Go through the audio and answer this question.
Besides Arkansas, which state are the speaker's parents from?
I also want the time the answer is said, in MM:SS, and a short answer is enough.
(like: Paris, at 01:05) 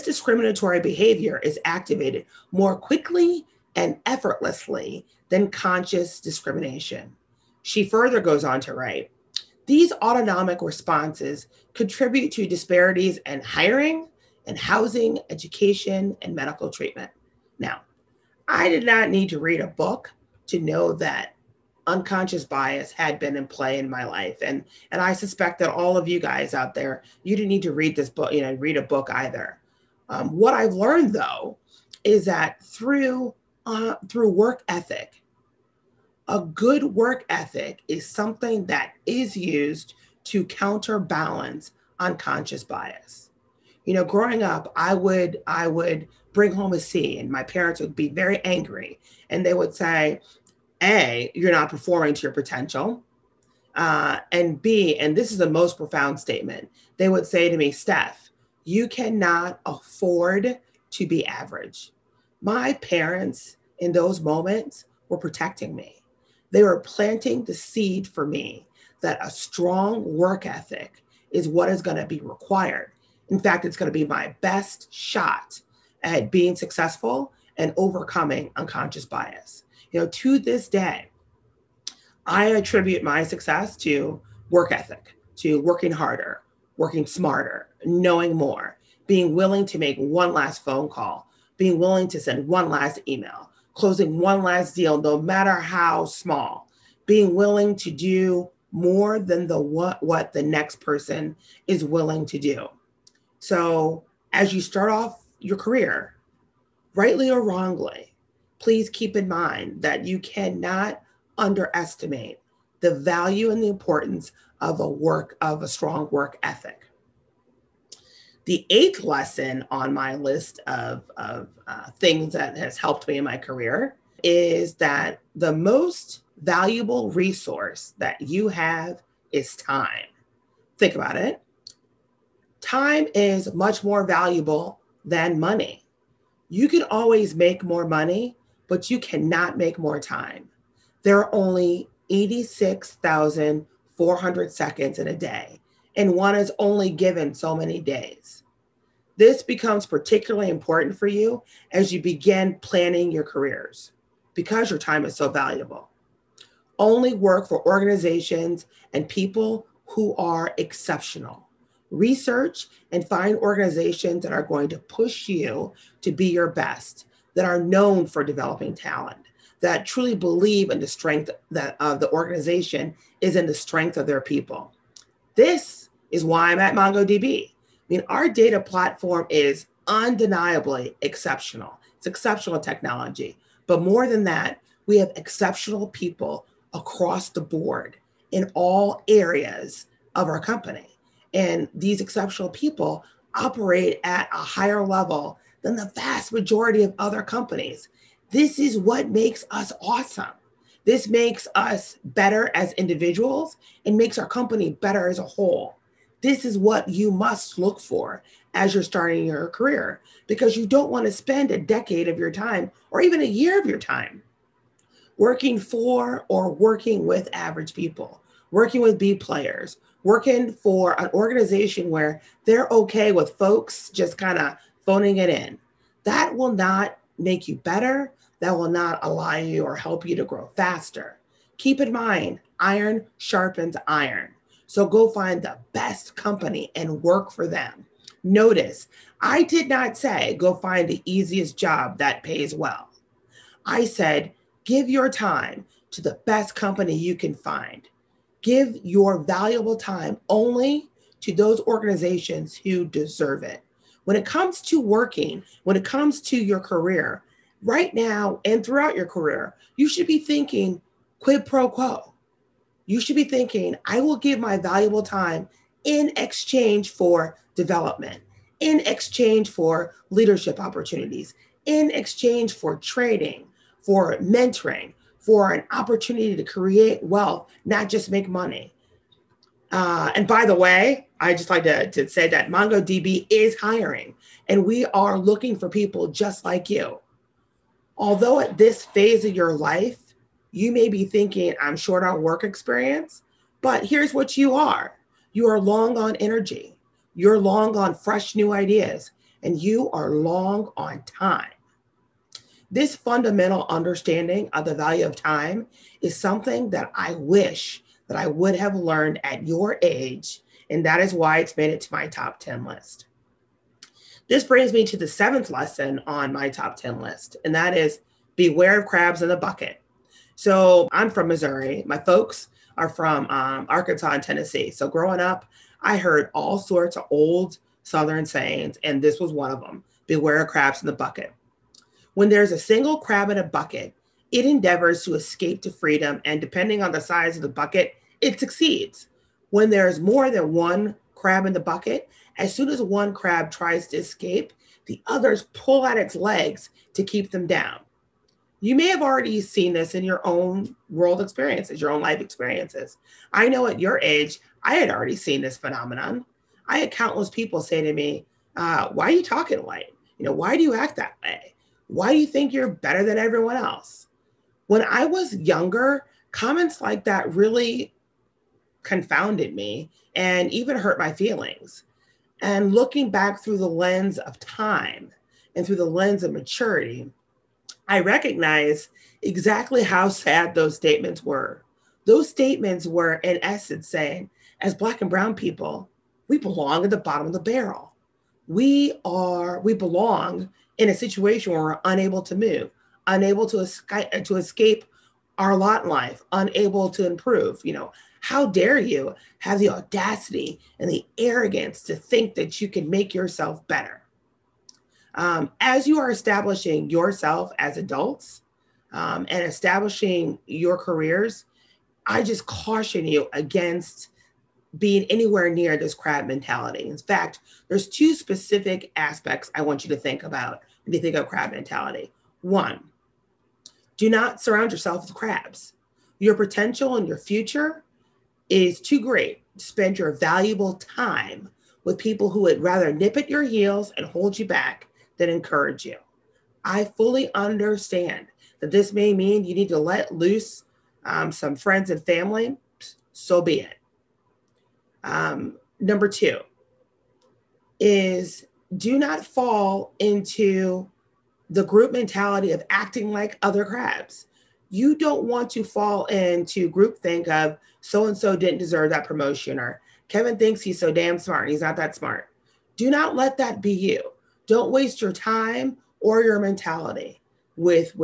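Tennessee, at 05:24.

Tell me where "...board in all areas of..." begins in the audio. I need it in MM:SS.
03:07.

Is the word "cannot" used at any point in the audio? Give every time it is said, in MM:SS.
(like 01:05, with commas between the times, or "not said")
00:58, 01:50, 02:18.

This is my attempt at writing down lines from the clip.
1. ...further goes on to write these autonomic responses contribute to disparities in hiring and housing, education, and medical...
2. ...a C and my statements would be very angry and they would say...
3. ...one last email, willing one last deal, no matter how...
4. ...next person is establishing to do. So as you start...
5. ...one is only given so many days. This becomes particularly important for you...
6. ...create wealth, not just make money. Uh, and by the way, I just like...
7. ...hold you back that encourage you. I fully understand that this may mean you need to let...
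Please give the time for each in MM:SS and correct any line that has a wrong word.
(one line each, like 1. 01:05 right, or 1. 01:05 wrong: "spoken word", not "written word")
1. 00:07 right
2. 00:46 wrong: "parents", not "statements"
3. 01:32 wrong: "closing", not "willing"
4. 01:40 wrong: "willing", not "establishing"
5. 02:26 right
6. 04:36 right
7. 07:14 right.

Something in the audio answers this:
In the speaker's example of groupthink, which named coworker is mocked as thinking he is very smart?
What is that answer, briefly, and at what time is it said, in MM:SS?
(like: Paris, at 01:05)
Kevin, at 07:40.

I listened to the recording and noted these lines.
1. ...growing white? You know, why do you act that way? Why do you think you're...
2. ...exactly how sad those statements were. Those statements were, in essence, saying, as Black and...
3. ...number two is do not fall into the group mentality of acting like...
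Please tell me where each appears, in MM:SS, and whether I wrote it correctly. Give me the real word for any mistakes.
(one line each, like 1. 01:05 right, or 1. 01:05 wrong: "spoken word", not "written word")
1. 05:59 wrong: "talking", not "growing"
2. 06:19 right
3. 07:25 right.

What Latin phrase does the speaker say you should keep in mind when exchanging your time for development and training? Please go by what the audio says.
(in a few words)
quid pro quo.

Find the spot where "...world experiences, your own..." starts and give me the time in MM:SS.
05:50.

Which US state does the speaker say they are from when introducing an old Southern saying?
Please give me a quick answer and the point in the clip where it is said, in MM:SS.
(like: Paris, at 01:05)
Missouri, at 05:21.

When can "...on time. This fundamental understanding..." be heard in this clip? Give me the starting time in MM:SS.
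05:00.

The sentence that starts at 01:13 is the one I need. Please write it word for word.
In fact, it's going to be my best shot at being successful and overcoming unconscious bias.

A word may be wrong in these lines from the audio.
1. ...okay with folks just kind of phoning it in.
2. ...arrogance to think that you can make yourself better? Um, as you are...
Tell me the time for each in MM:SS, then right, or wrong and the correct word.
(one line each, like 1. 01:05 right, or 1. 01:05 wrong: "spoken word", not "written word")
1. 03:42 right
2. 06:41 right.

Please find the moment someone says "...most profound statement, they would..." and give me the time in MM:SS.
00:55.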